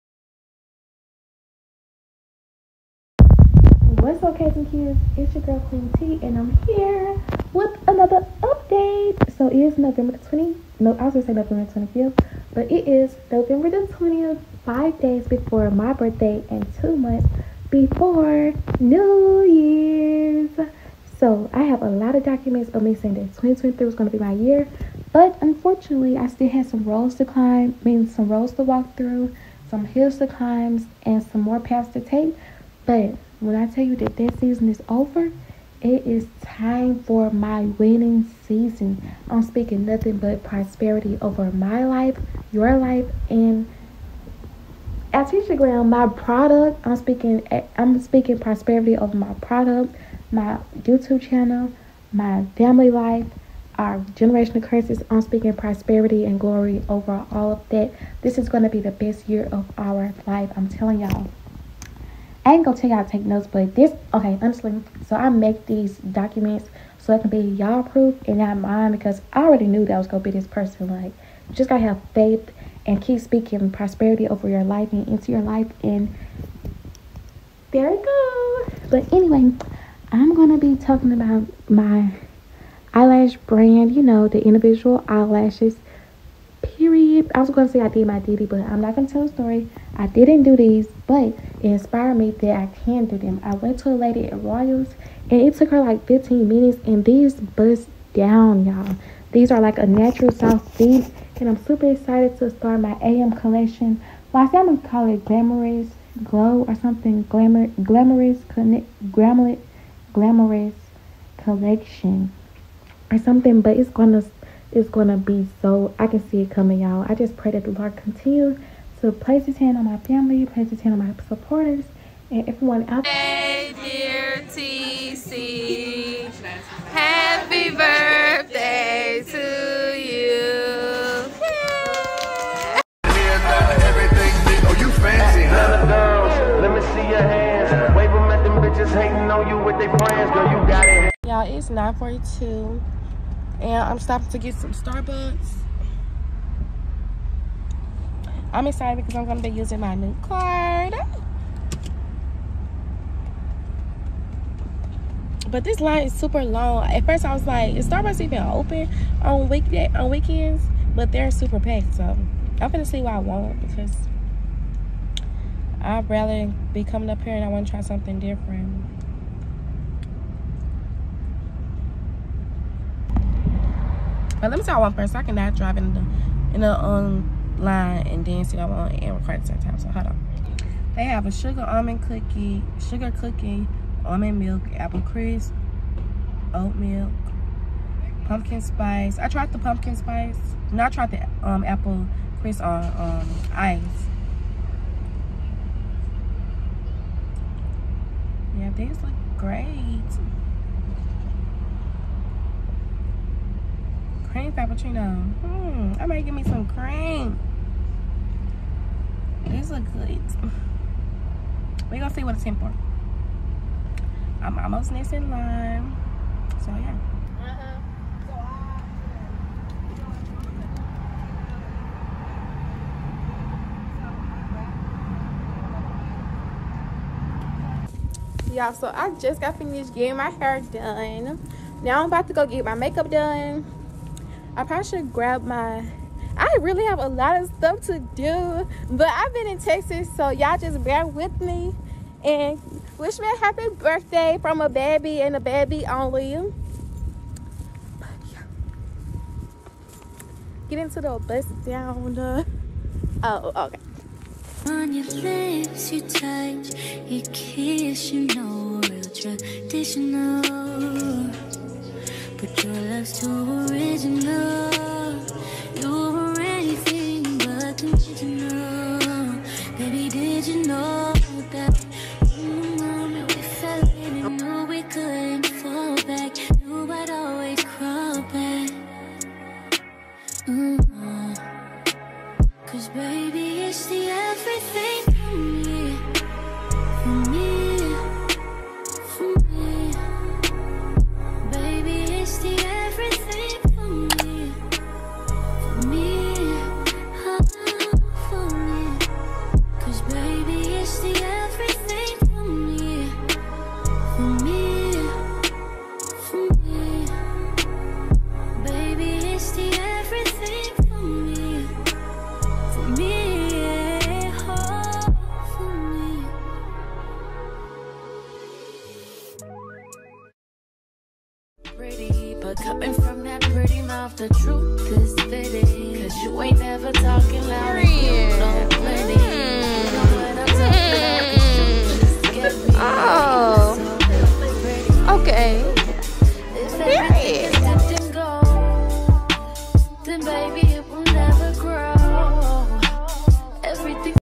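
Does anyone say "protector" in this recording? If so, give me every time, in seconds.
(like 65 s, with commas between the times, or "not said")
not said.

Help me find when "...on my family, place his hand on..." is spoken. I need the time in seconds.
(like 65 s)
119 s.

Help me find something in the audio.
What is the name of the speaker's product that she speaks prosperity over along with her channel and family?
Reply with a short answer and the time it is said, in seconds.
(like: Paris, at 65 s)
AlTesha Glam, at 45 s.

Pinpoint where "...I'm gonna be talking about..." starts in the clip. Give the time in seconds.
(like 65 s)
80 s.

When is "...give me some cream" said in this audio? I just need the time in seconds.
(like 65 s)
206 s.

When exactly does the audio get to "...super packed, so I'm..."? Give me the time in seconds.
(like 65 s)
161 s.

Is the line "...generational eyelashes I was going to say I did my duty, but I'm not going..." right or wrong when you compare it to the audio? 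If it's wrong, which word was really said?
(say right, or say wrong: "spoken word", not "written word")
wrong: "individual", not "generational".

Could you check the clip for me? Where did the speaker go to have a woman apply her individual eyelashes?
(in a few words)
Royals.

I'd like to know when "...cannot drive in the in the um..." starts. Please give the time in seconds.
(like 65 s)
175 s.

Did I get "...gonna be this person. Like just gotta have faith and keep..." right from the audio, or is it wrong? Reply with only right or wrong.
right.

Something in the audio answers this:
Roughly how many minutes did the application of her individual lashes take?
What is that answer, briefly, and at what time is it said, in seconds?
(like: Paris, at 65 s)
15, at 96 s.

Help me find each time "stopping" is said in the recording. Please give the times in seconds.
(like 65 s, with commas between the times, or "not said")
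143 s.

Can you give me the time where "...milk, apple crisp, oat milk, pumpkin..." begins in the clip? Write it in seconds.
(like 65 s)
184 s.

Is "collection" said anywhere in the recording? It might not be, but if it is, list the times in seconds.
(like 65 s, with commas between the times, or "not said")
103 s, 111 s.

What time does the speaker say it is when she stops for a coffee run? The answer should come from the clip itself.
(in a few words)
9:42.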